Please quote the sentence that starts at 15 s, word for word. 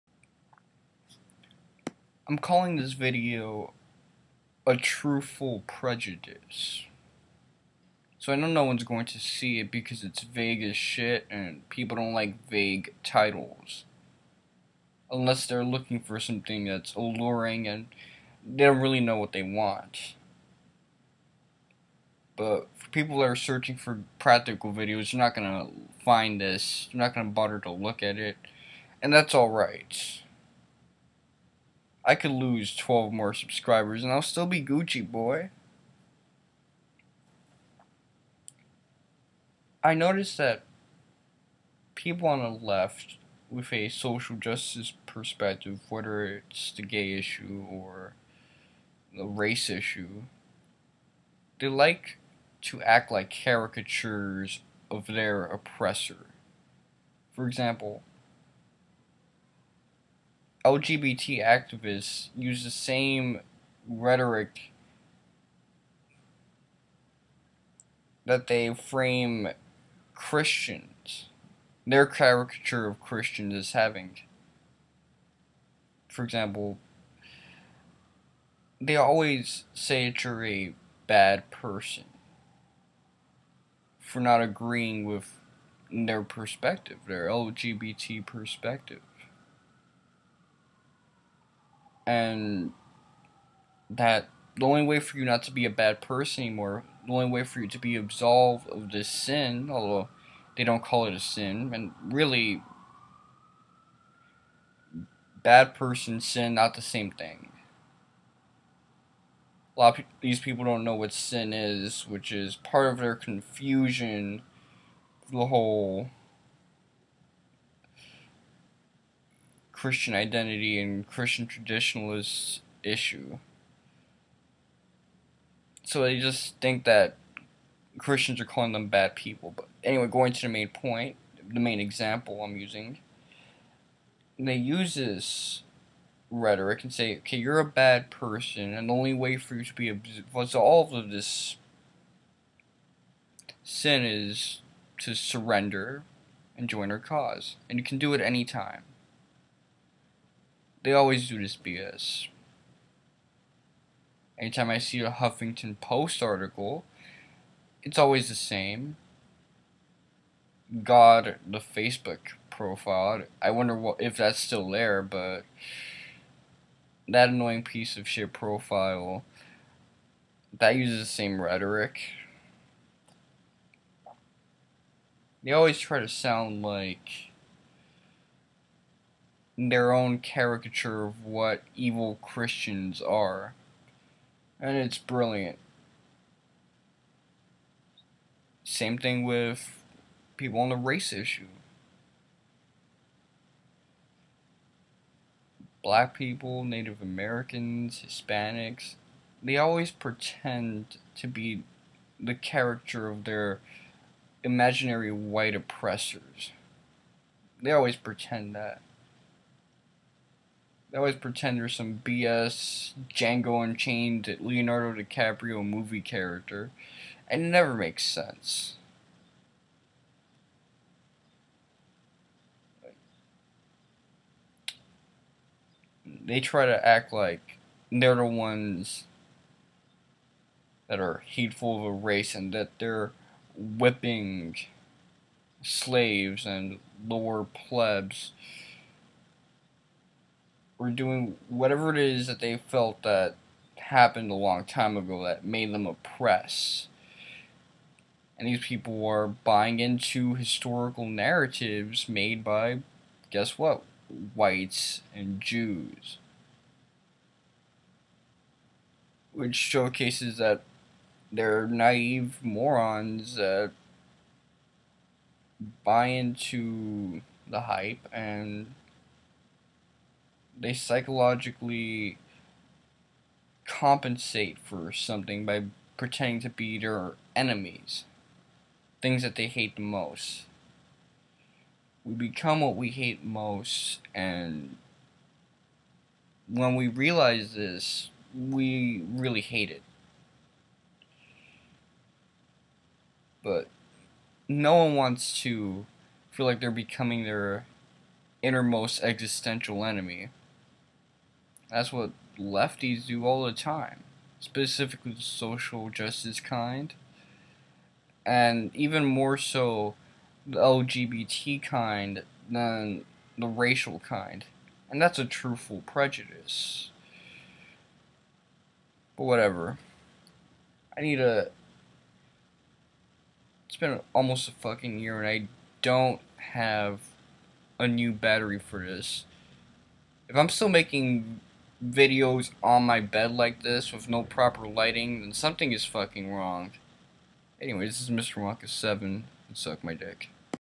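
Unless they're looking for something that's alluring and they don't really know what they want.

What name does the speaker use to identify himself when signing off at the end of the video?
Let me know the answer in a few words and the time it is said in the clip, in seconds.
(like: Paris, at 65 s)
Mr. Wonka 7, at 338 s.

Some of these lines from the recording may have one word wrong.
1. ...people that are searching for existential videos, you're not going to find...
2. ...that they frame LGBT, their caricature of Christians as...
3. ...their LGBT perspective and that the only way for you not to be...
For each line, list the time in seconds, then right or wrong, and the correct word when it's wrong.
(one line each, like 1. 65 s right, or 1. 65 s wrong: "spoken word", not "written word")
1. 22 s wrong: "practical", not "existential"
2. 68 s wrong: "Christians", not "LGBT"
3. 87 s right.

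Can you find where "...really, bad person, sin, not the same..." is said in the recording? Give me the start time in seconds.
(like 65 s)
102 s.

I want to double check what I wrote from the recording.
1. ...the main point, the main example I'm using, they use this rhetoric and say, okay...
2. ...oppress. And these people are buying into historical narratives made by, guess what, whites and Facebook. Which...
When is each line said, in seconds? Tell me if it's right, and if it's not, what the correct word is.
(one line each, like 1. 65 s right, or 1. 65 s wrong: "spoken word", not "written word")
1. 130 s right
2. 245 s wrong: "Jews", not "Facebook".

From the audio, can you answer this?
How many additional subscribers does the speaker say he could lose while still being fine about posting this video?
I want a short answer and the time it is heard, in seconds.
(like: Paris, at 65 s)
12, at 32 s.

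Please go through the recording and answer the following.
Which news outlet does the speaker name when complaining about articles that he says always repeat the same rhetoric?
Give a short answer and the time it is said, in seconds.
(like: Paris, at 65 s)
Huffington Post, at 155 s.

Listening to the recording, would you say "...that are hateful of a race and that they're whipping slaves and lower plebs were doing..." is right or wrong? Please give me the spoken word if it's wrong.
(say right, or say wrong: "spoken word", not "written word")
right.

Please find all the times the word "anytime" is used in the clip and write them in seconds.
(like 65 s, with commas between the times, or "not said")
148 s, 154 s.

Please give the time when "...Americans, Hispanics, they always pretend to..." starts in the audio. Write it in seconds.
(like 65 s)
197 s.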